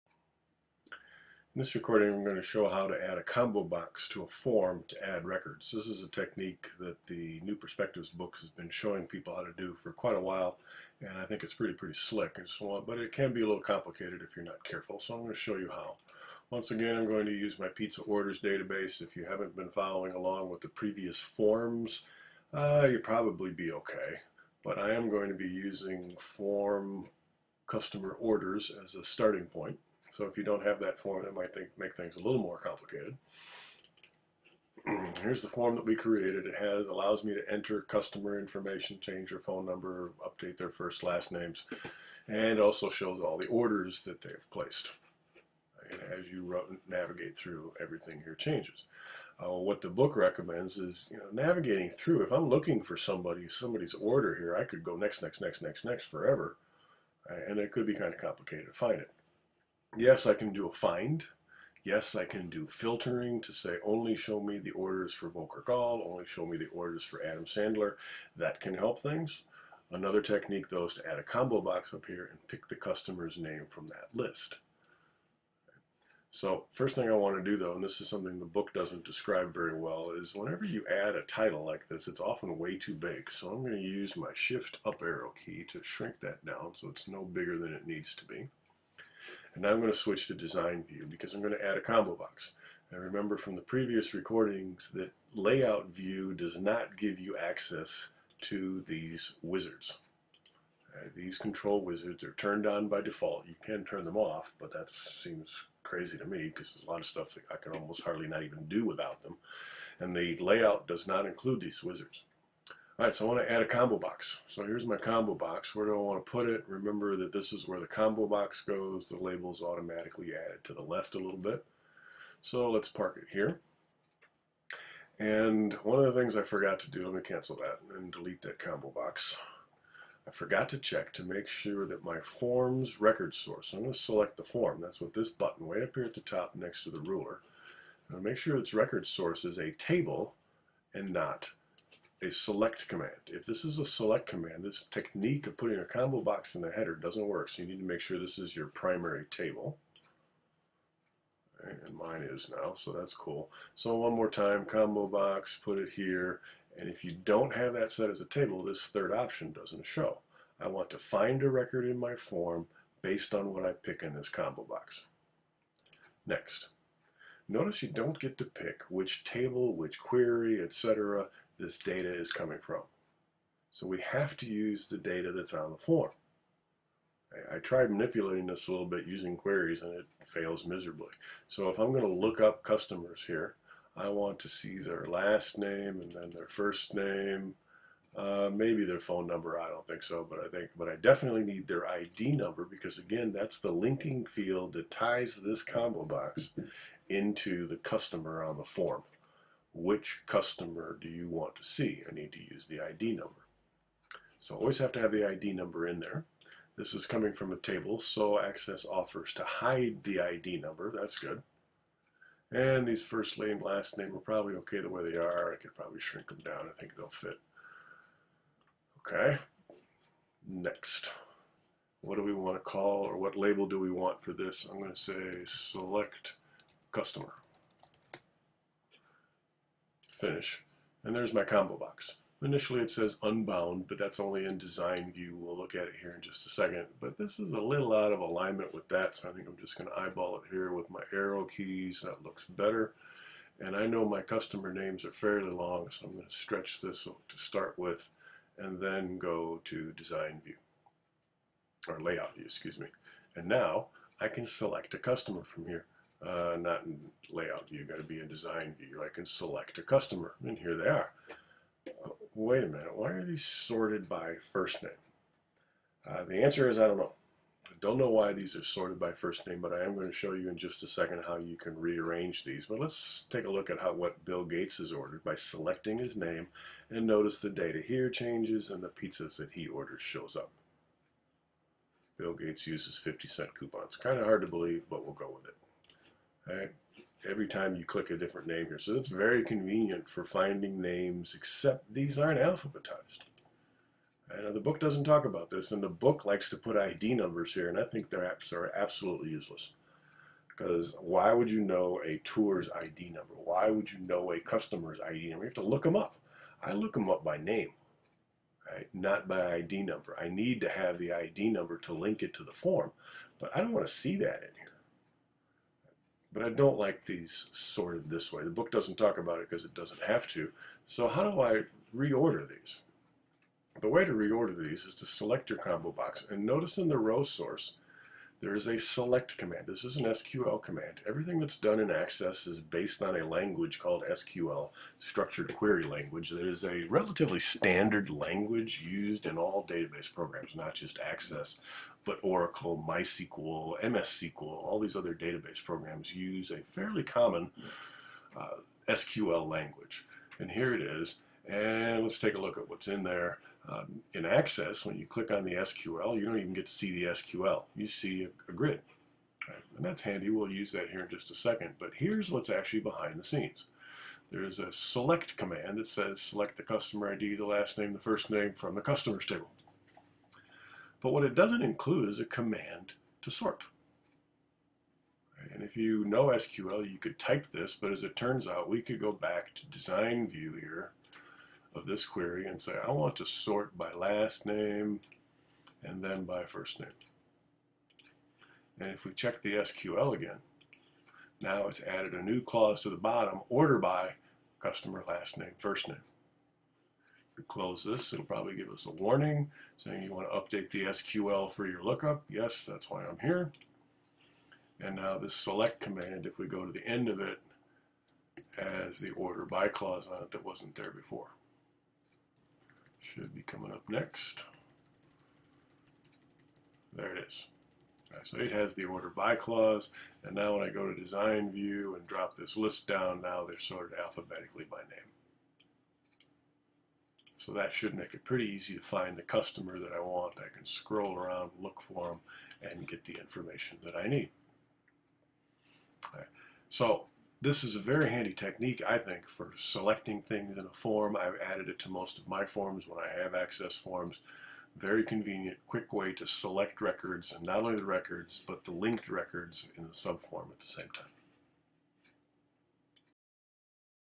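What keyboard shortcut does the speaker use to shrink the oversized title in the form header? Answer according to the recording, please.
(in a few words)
Shift up arrow.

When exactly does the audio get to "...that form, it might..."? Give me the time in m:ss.
0:30.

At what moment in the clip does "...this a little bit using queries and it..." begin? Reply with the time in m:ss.
2:58.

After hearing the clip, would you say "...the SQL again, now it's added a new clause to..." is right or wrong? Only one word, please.
right.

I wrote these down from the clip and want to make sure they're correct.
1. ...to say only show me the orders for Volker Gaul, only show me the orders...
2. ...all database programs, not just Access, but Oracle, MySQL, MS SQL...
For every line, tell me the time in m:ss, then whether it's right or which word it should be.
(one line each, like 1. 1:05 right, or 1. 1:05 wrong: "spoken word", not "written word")
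1. 1:03 right
2. 5:39 right.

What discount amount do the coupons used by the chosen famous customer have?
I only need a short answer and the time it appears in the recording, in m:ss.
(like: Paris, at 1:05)
50 cent, at 4:42.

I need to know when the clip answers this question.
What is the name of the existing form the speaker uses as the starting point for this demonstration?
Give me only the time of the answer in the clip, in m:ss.
0:27.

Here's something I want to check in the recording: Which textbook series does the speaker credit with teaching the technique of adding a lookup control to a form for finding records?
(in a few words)
New Perspectives.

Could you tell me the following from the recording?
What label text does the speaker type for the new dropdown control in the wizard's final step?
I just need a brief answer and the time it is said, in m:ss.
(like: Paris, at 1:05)
select customer, at 3:45.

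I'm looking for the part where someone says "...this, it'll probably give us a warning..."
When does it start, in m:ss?
6:37.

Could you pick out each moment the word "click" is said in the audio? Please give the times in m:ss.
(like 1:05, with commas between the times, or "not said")
4:47, 5:55.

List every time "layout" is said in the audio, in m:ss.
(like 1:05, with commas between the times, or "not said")
1:35, 1:50, 4:12, 4:17.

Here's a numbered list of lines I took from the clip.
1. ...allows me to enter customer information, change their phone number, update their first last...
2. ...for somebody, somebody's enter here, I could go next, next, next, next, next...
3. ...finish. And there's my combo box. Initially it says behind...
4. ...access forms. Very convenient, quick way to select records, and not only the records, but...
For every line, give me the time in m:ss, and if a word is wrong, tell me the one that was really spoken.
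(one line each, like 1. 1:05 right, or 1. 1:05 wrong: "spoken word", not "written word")
1. 0:36 right
2. 0:52 wrong: "order", not "enter"
3. 3:50 wrong: "unbound", not "behind"
4. 7:23 right.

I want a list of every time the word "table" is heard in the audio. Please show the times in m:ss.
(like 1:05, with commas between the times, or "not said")
2:19, 2:29, 2:38, 2:49, 3:27, 6:09.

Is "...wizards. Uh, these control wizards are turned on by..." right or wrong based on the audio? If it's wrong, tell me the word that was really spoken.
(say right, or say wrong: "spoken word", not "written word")
right.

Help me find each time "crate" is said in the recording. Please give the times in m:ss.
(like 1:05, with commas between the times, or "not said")
not said.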